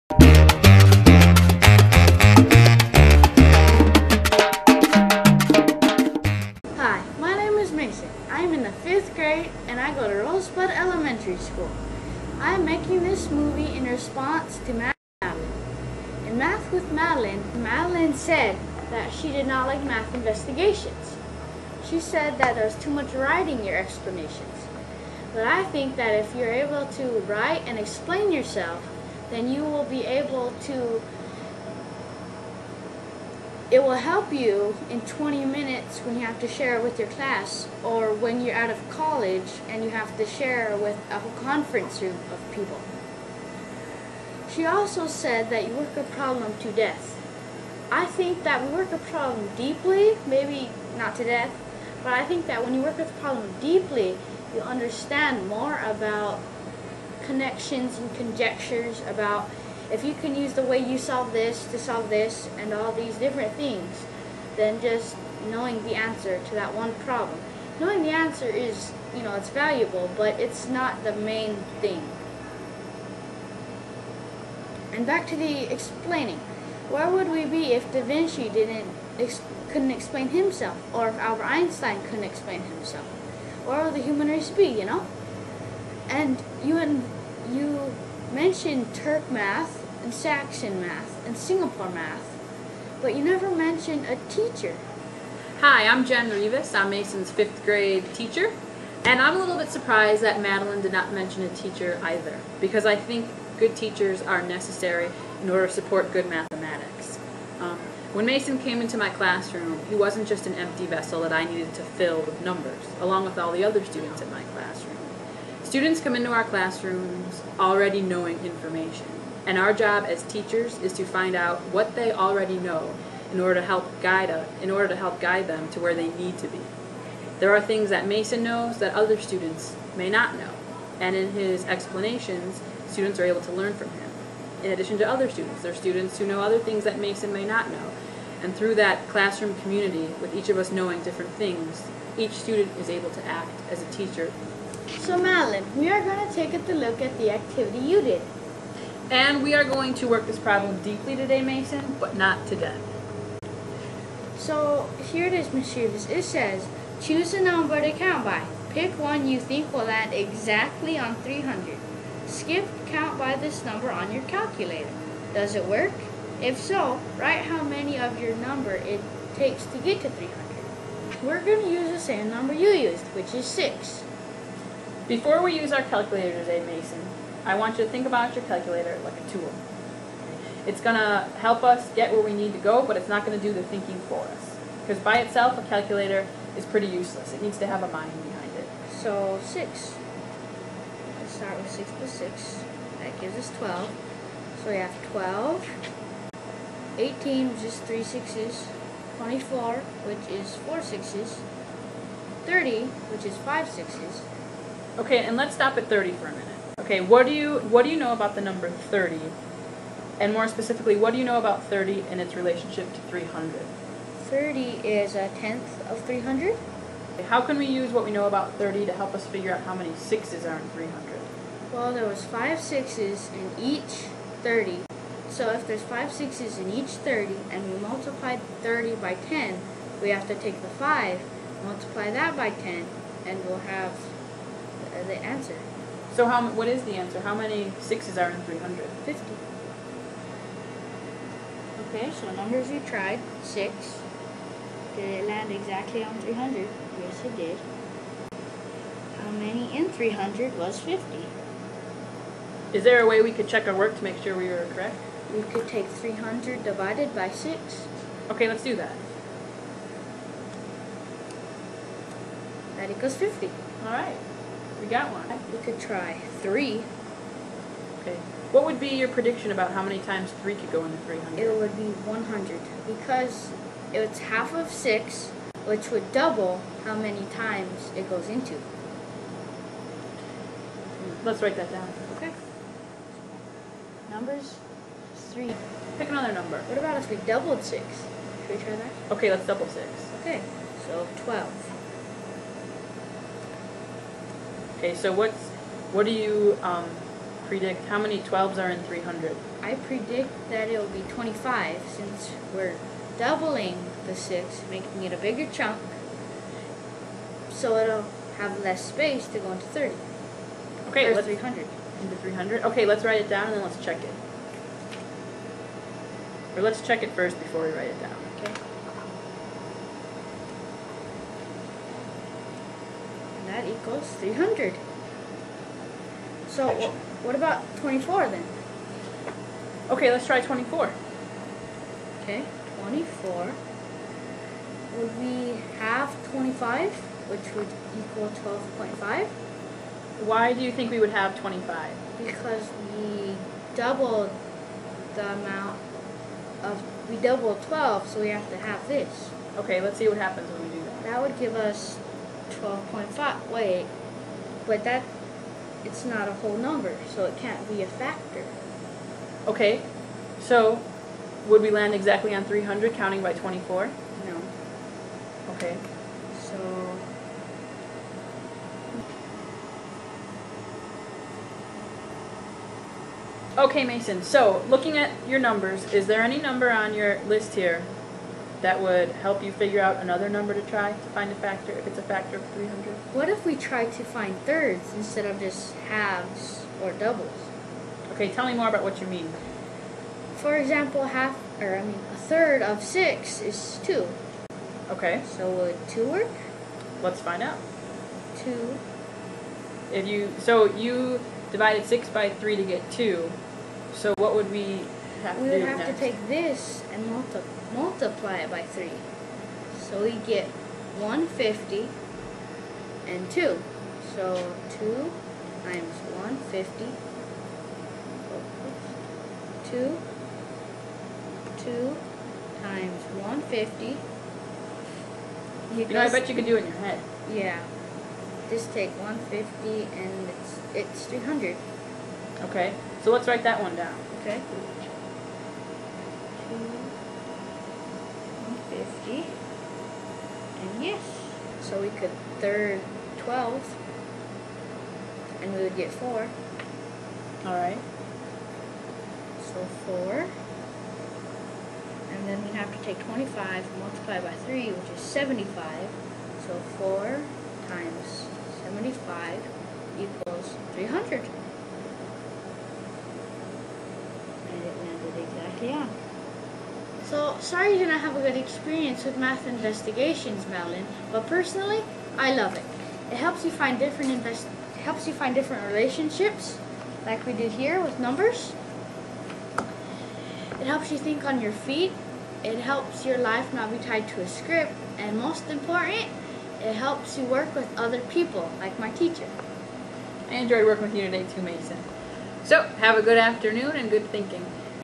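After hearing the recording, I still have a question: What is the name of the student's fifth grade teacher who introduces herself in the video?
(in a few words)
Jen Rivas.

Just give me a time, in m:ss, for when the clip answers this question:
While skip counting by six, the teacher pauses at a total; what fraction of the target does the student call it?
3:35.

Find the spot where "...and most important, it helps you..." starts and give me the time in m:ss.
8:04.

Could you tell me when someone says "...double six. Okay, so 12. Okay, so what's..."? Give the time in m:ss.
4:49.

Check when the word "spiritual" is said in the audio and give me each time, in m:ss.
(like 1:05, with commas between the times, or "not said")
not said.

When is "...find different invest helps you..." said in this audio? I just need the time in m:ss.
7:53.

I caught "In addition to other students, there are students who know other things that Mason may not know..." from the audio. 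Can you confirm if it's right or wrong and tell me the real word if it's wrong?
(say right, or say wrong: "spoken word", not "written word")
right.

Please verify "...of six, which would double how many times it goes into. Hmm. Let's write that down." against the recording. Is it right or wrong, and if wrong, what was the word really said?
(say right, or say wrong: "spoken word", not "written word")
right.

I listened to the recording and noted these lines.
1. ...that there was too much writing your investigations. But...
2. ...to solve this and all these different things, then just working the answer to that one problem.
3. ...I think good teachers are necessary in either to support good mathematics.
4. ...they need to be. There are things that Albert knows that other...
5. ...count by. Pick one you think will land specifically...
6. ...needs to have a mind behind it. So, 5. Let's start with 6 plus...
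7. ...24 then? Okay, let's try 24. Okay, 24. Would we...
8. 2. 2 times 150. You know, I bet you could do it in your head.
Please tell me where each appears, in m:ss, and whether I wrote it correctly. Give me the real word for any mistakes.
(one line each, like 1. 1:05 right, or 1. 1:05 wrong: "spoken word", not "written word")
1. 0:22 wrong: "explanations", not "investigations"
2. 1:01 wrong: "knowing", not "working"
3. 1:42 wrong: "order", not "either"
4. 2:05 wrong: "Mason", not "Albert"
5. 2:37 wrong: "exactly", not "specifically"
6. 3:07 wrong: "6", not "5"
7. 5:27 right
8. 6:59 right.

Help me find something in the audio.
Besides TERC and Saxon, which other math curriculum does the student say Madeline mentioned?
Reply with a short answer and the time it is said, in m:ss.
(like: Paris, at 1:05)
Singapore math, at 1:31.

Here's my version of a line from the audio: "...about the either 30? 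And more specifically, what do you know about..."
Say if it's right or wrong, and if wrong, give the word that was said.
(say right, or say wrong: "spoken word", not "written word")
wrong: "number", not "either".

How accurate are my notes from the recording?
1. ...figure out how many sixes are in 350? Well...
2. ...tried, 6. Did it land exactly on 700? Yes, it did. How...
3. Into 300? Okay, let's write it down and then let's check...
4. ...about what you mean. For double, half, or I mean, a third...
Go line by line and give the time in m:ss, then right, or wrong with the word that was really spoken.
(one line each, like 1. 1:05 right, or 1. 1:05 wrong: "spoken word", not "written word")
1. 3:39 wrong: "300", not "350"
2. 4:02 wrong: "300", not "700"
3. 5:12 right
4. 6:28 wrong: "example", not "double".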